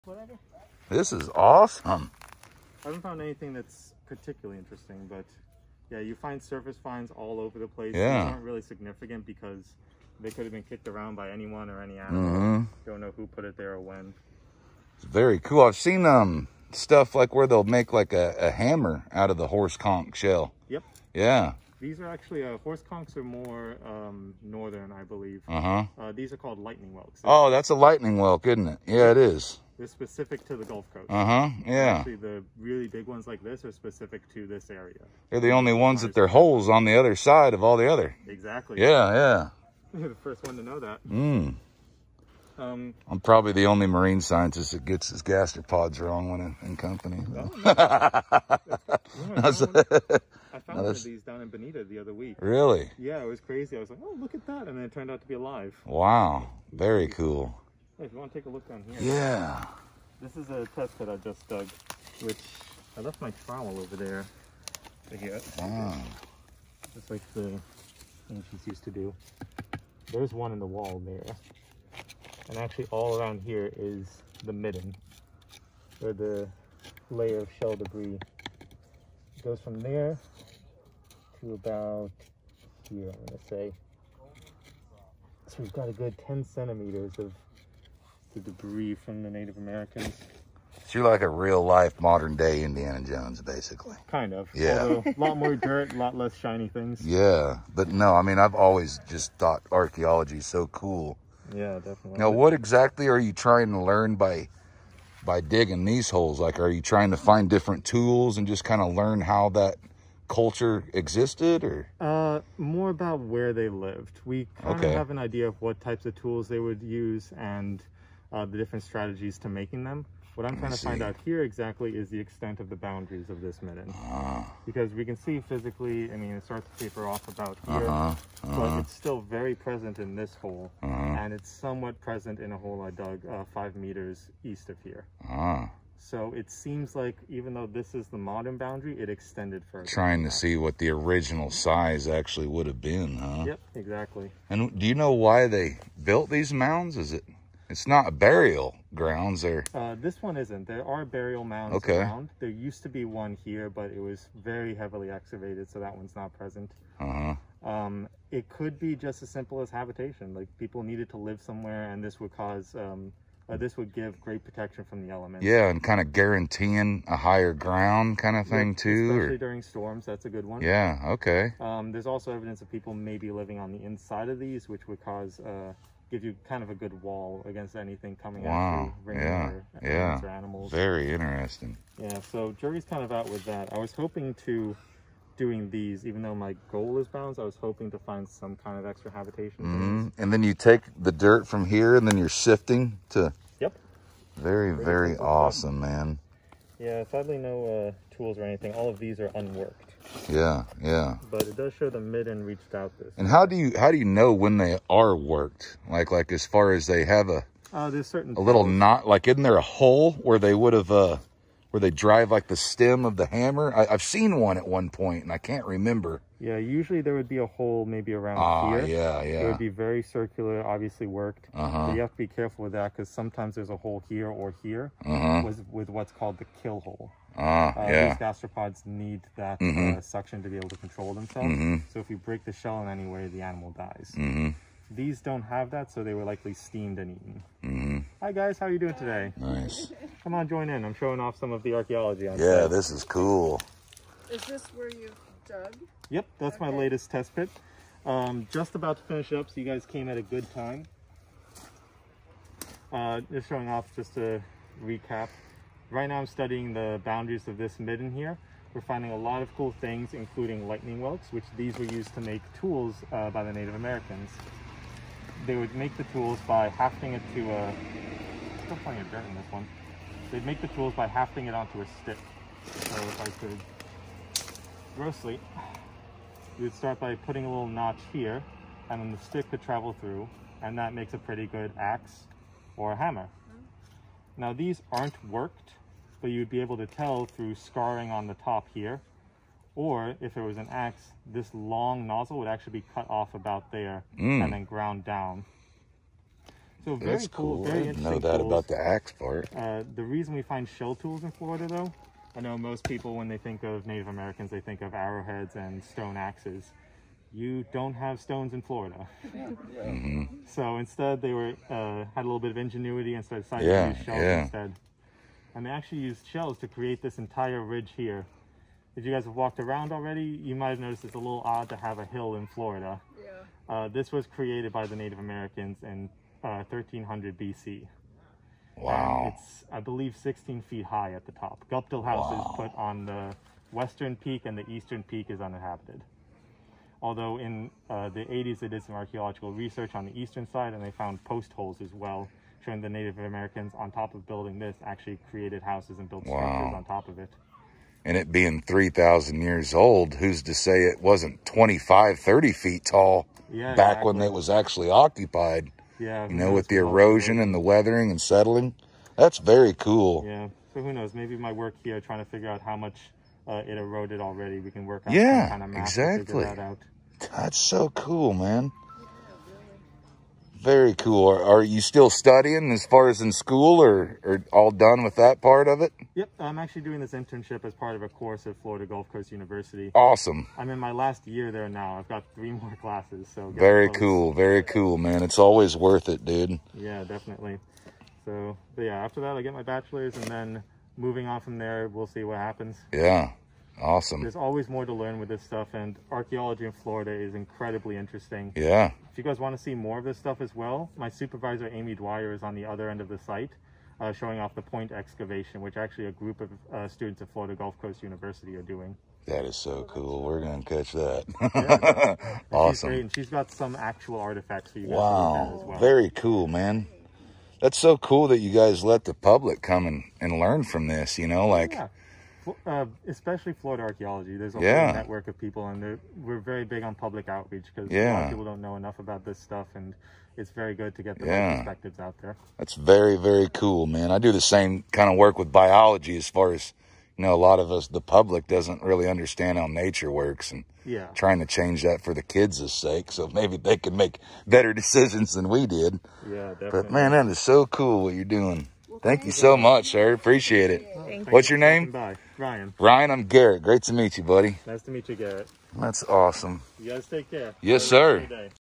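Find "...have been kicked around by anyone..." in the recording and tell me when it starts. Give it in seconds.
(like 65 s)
10 s.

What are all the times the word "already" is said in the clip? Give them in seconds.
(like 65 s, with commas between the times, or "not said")
319 s, 364 s.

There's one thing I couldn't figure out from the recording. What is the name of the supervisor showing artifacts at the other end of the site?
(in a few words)
Amy Dwyer.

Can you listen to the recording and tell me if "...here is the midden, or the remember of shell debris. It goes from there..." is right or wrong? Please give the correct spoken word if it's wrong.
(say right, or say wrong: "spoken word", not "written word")
wrong: "layer", not "remember".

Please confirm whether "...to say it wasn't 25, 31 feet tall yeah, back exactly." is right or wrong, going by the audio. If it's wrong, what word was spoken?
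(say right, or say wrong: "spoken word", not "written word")
wrong: "30", not "31".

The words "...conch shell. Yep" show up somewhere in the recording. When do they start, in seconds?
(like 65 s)
19 s.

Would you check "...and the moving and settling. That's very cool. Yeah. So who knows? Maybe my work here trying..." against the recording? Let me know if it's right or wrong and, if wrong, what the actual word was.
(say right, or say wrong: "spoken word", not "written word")
wrong: "weathering", not "moving".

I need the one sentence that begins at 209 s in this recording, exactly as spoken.
Like isn't there a hole where they would have uh where they drive like the stem of the hammer?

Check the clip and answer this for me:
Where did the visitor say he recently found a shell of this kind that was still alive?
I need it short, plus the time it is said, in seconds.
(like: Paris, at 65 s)
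Bonita, at 51 s.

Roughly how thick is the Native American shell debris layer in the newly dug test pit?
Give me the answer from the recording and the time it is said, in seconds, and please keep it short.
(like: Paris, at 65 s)
10 centimeters, at 86 s.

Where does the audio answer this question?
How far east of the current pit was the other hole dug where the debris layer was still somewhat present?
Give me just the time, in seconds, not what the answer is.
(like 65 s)
133 s.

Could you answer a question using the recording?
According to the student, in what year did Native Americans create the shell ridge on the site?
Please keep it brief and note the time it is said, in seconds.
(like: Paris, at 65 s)
1300 BC, at 326 s.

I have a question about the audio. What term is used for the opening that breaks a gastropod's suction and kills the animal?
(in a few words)
kill hole.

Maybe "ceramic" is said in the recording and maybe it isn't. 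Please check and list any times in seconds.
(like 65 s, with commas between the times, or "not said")
not said.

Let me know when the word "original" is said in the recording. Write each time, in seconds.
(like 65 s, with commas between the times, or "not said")
140 s.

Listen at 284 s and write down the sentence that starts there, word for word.
Now these aren't worked, but you'd be able to tell through scarring on the top here.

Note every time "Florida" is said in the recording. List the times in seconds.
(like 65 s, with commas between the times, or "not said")
301 s, 308 s, 322 s, 378 s, 396 s, 407 s, 423 s.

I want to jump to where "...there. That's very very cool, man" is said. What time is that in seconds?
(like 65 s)
432 s.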